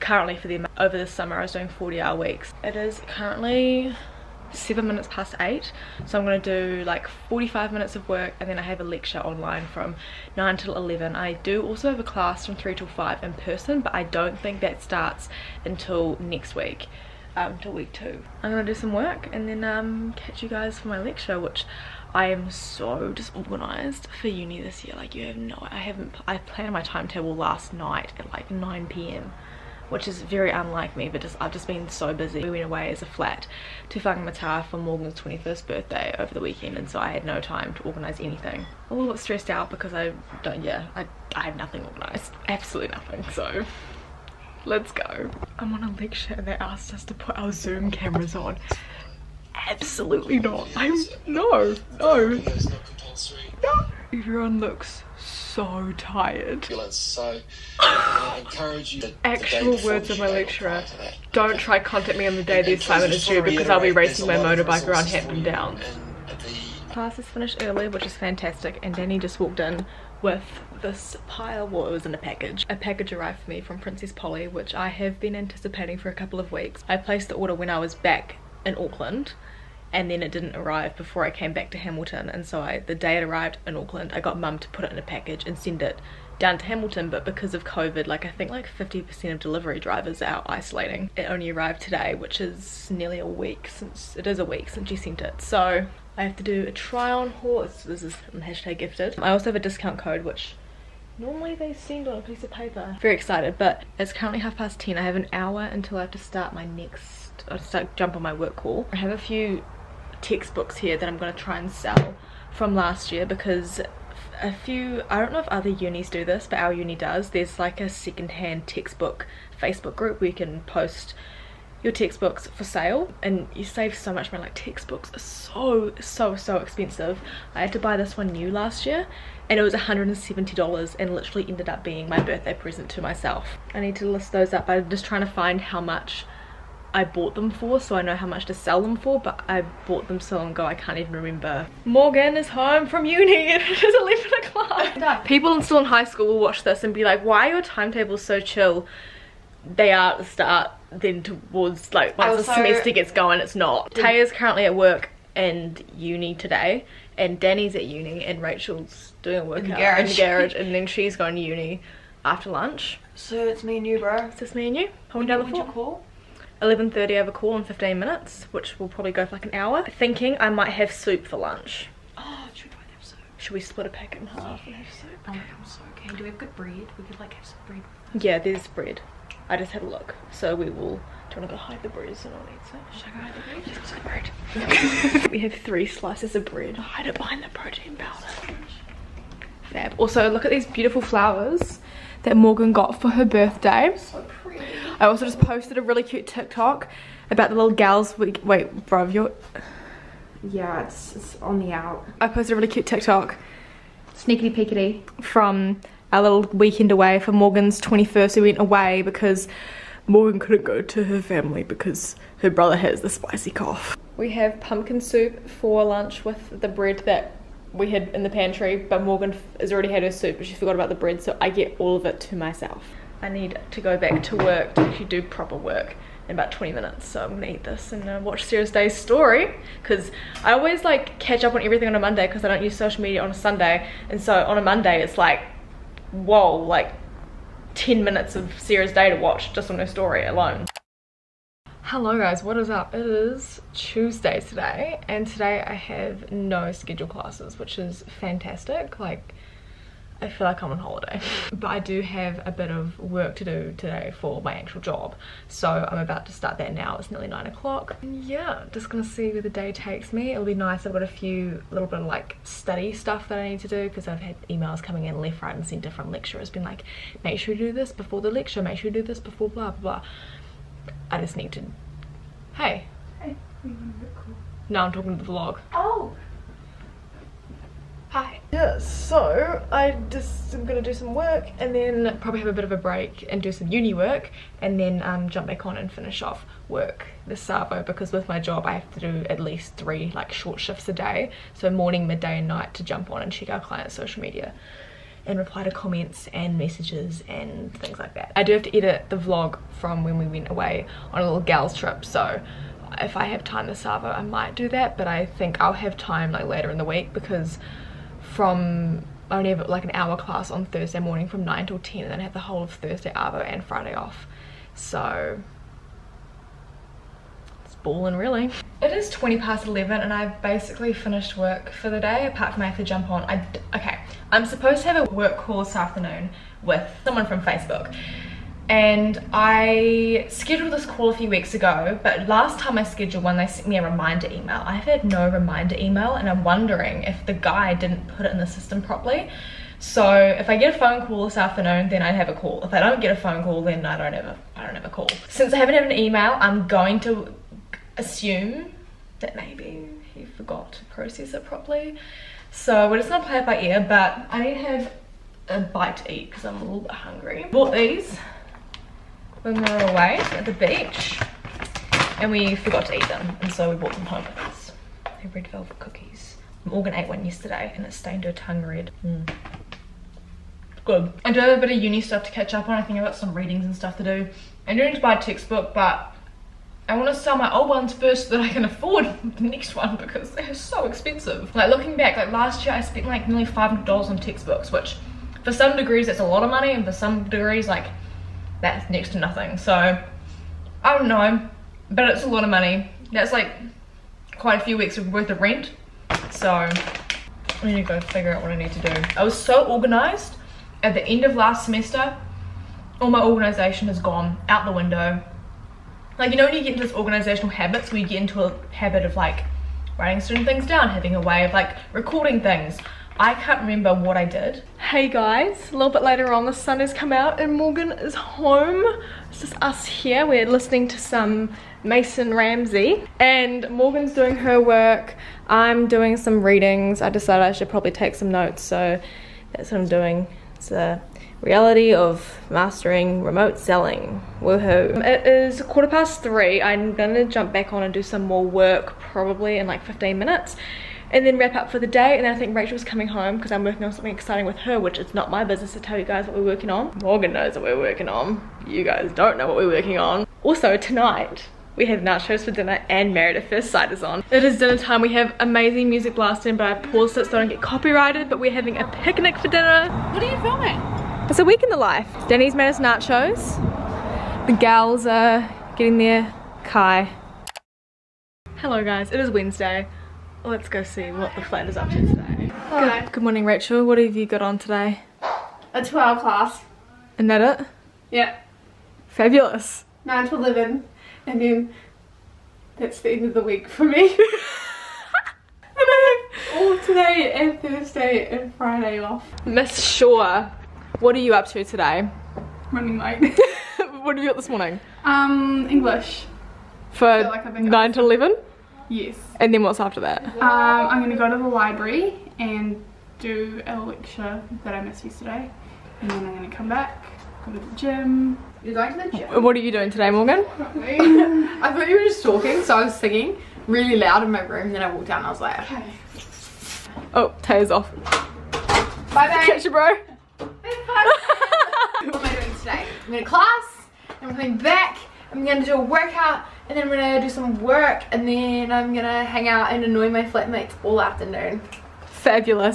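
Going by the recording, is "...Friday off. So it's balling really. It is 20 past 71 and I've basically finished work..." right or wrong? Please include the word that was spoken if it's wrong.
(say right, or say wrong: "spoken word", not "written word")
wrong: "11", not "71".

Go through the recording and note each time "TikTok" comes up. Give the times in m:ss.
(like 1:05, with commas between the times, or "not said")
3:16, 3:22.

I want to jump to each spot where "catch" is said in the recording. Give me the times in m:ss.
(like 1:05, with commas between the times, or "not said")
0:20, 3:51, 6:12, 8:39.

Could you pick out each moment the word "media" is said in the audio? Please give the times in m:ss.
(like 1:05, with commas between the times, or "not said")
3:53, 4:54.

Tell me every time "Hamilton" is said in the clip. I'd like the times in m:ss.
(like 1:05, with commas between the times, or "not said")
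1:21, 1:26.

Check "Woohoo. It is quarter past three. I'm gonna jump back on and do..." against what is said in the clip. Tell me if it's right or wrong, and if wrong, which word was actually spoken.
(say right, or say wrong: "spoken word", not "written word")
right.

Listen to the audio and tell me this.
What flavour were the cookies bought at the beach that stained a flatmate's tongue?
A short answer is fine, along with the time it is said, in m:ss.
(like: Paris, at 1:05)
Red velvet, at 6:05.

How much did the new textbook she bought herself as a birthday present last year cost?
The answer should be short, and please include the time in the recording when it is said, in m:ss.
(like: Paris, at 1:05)
$170, at 2:09.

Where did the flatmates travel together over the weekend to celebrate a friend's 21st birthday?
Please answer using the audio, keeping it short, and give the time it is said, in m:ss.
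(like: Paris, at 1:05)
Whangamata, at 0:33.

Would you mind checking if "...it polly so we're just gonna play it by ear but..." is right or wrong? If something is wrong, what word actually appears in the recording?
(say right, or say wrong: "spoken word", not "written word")
wrong: "properly", not "polly".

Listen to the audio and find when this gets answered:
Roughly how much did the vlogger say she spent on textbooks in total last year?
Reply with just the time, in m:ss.
6:23.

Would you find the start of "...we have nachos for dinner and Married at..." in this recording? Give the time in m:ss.
7:31.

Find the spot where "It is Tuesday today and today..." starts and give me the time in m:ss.
4:02.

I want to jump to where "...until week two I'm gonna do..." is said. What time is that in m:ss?
0:17.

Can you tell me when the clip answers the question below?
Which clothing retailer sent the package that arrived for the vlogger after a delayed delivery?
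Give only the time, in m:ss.
1:13.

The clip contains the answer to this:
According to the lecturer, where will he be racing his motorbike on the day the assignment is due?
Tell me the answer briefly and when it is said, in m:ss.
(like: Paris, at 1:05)
Hampton Down, at 1:05.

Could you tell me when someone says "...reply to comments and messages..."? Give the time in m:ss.
4:55.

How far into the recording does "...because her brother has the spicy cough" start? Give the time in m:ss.
3:31.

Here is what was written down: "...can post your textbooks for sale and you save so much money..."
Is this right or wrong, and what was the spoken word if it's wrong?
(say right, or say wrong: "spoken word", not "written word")
right.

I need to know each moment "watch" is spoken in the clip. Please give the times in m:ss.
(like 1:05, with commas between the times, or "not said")
2:26, 3:48, 3:59.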